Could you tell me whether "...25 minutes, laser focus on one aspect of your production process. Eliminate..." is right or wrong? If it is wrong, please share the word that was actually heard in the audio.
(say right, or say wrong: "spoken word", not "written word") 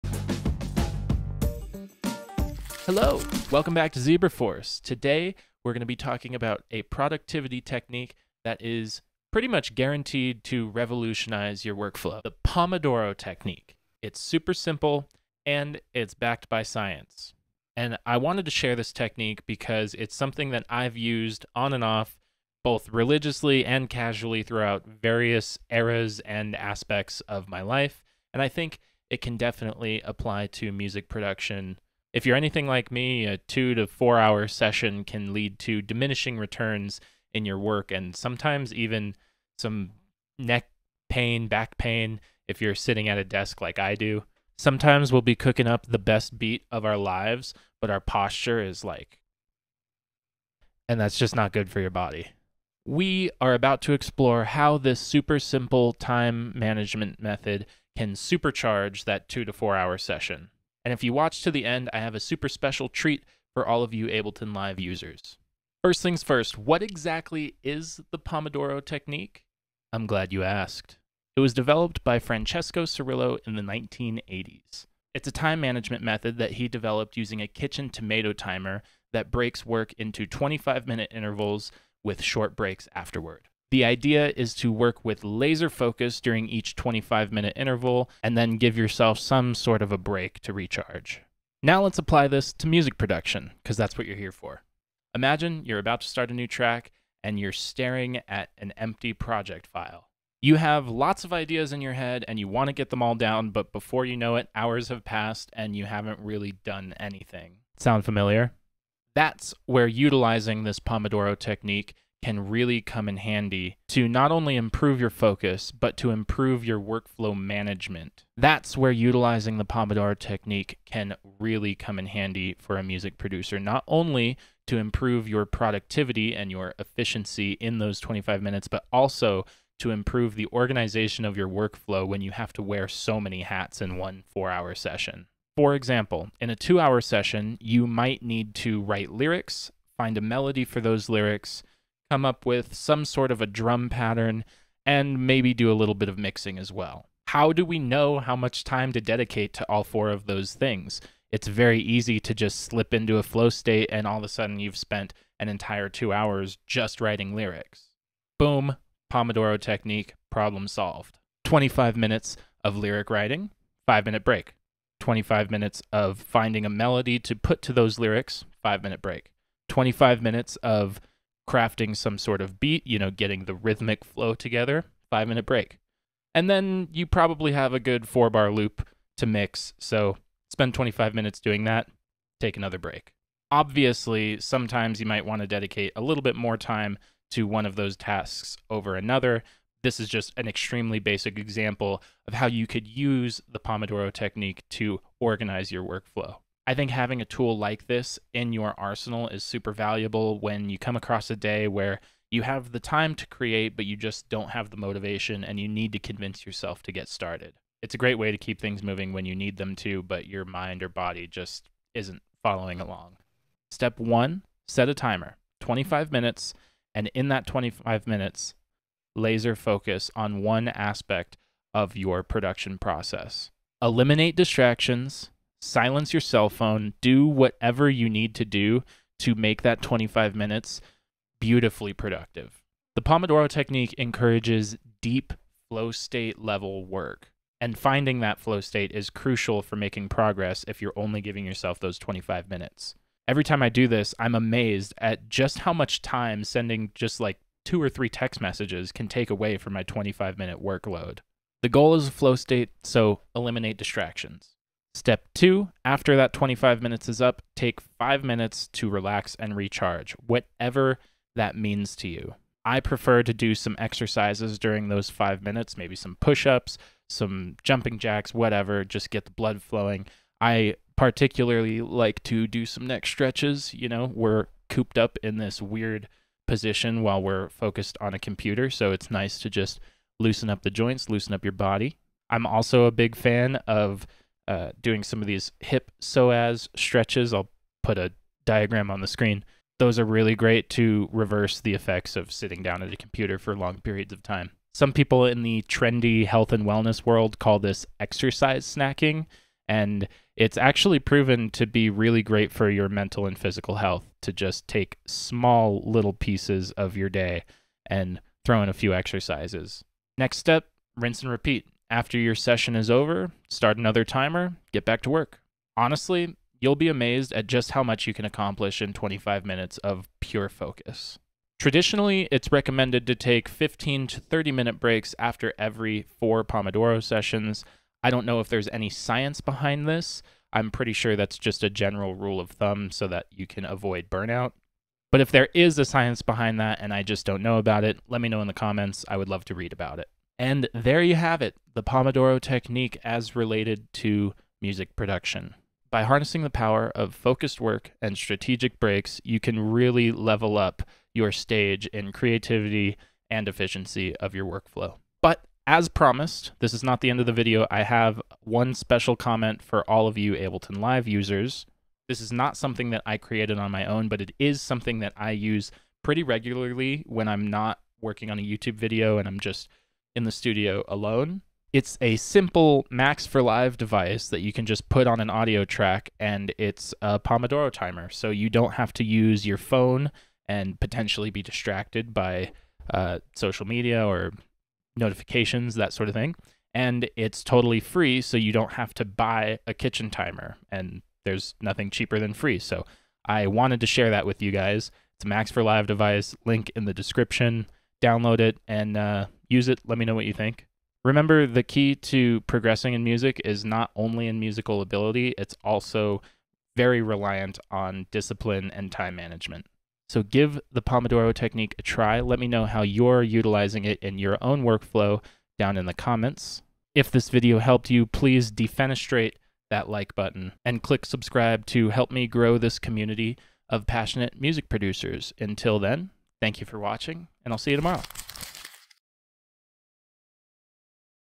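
right.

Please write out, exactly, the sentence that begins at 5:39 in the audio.
I would love to read about it.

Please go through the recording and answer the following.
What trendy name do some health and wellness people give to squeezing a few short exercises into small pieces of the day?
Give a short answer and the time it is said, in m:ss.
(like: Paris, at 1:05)
exercise snacking, at 4:57.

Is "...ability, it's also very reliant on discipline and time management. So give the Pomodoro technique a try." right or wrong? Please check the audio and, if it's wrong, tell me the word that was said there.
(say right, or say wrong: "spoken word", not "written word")
right.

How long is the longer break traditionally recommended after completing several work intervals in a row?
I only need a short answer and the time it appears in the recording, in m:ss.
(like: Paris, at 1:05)
15 to 30 minutes, at 5:23.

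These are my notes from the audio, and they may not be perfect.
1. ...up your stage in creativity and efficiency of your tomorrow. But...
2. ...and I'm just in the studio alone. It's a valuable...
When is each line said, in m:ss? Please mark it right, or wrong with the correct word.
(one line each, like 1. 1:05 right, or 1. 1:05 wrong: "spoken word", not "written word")
1. 5:50 wrong: "workflow", not "tomorrow"
2. 6:09 wrong: "simple", not "valuable".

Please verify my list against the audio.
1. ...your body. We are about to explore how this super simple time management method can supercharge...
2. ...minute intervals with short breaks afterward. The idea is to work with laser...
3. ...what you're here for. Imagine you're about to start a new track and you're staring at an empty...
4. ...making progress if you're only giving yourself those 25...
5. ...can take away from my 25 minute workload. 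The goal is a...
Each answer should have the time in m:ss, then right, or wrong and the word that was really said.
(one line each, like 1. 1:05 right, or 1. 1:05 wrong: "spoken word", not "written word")
1. 0:51 right
2. 1:20 right
3. 1:33 right
4. 3:59 right
5. 4:08 right.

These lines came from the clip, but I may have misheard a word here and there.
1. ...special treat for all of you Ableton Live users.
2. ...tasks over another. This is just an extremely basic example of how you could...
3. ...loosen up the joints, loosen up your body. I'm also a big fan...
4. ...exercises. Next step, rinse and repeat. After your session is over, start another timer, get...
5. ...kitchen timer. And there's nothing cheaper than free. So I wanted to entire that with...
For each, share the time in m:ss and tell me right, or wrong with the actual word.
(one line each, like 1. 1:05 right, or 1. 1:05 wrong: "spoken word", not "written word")
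1. 1:02 right
2. 3:07 right
3. 4:40 right
4. 5:08 right
5. 6:29 wrong: "share", not "entire".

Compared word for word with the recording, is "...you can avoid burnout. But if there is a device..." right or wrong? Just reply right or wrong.
wrong.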